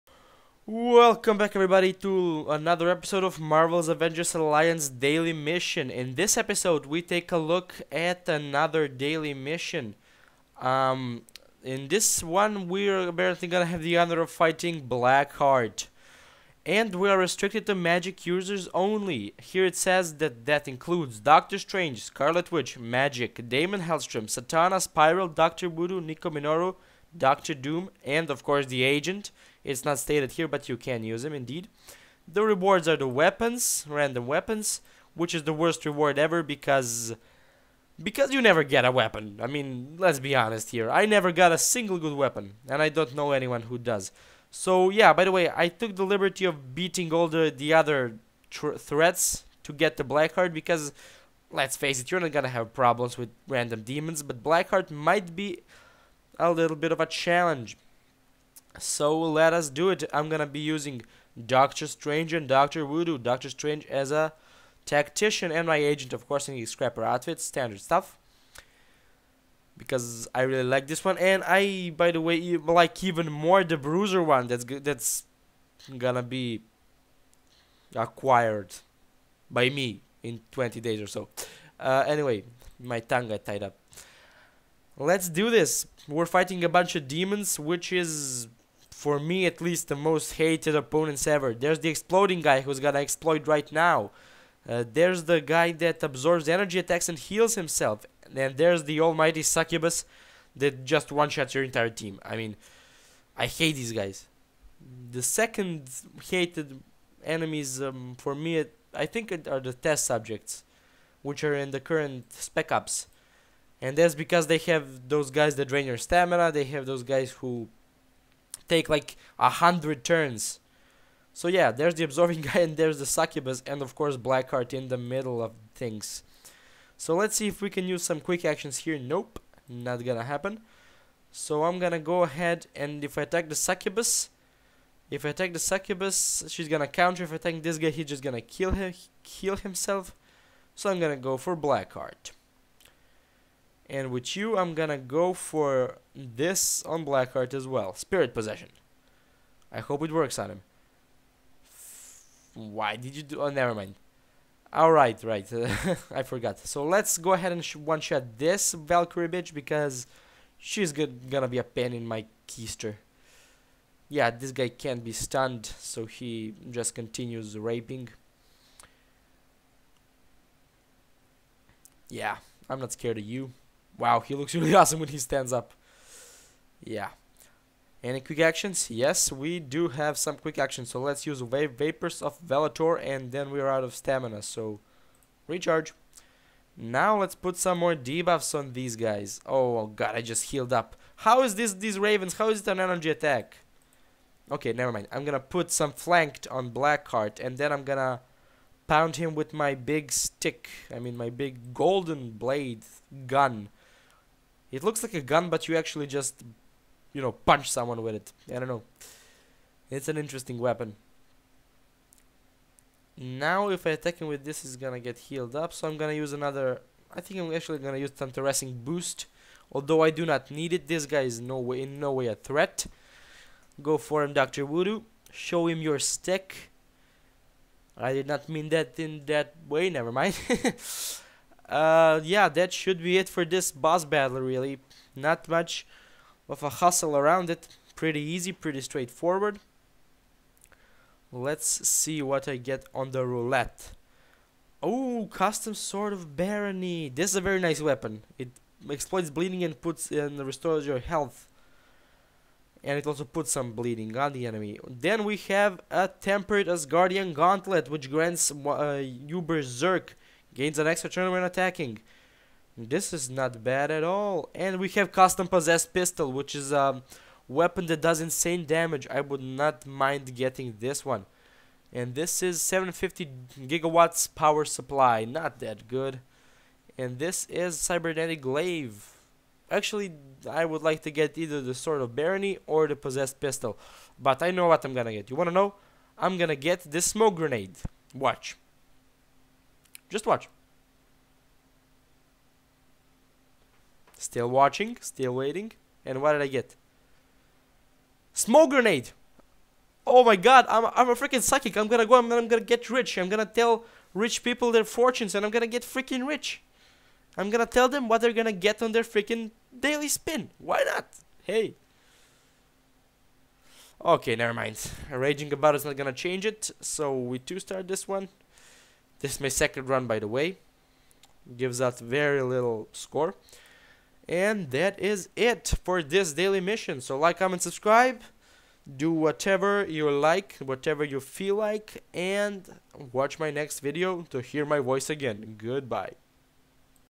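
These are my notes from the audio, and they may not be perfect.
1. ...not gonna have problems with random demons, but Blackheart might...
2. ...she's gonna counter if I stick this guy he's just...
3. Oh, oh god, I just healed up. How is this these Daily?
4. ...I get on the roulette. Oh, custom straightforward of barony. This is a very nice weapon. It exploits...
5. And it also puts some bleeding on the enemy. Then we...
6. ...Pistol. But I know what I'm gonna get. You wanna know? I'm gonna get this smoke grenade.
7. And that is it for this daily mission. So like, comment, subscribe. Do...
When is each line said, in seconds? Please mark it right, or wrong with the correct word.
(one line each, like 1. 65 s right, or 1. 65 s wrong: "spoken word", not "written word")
1. 52 s right
2. 136 s wrong: "attack", not "stick"
3. 189 s wrong: "Ravens", not "Daily"
4. 242 s wrong: "sword", not "straightforward"
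5. 252 s right
6. 283 s right
7. 324 s right.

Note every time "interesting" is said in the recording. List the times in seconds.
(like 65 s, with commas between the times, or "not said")
210 s.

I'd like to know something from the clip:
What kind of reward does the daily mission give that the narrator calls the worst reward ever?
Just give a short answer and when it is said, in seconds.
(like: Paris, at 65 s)
Random weapons, at 33 s.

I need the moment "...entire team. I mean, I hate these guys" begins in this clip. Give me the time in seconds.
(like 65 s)
101 s.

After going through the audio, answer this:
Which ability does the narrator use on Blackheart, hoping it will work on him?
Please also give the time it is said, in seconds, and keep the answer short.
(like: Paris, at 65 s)
Spirit Possession, at 147 s.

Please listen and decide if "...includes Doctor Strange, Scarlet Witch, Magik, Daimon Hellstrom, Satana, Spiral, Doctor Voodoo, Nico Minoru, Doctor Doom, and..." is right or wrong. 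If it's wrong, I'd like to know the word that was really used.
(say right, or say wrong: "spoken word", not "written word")
right.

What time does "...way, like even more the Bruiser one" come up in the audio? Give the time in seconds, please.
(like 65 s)
72 s.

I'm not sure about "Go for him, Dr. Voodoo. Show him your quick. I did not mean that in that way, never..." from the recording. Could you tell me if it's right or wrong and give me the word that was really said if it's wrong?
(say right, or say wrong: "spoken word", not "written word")
wrong: "stick", not "quick".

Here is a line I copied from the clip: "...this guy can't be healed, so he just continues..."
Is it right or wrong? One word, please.
wrong.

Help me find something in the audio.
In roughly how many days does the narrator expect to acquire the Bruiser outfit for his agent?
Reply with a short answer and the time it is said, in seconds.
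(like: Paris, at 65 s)
20 days, at 80 s.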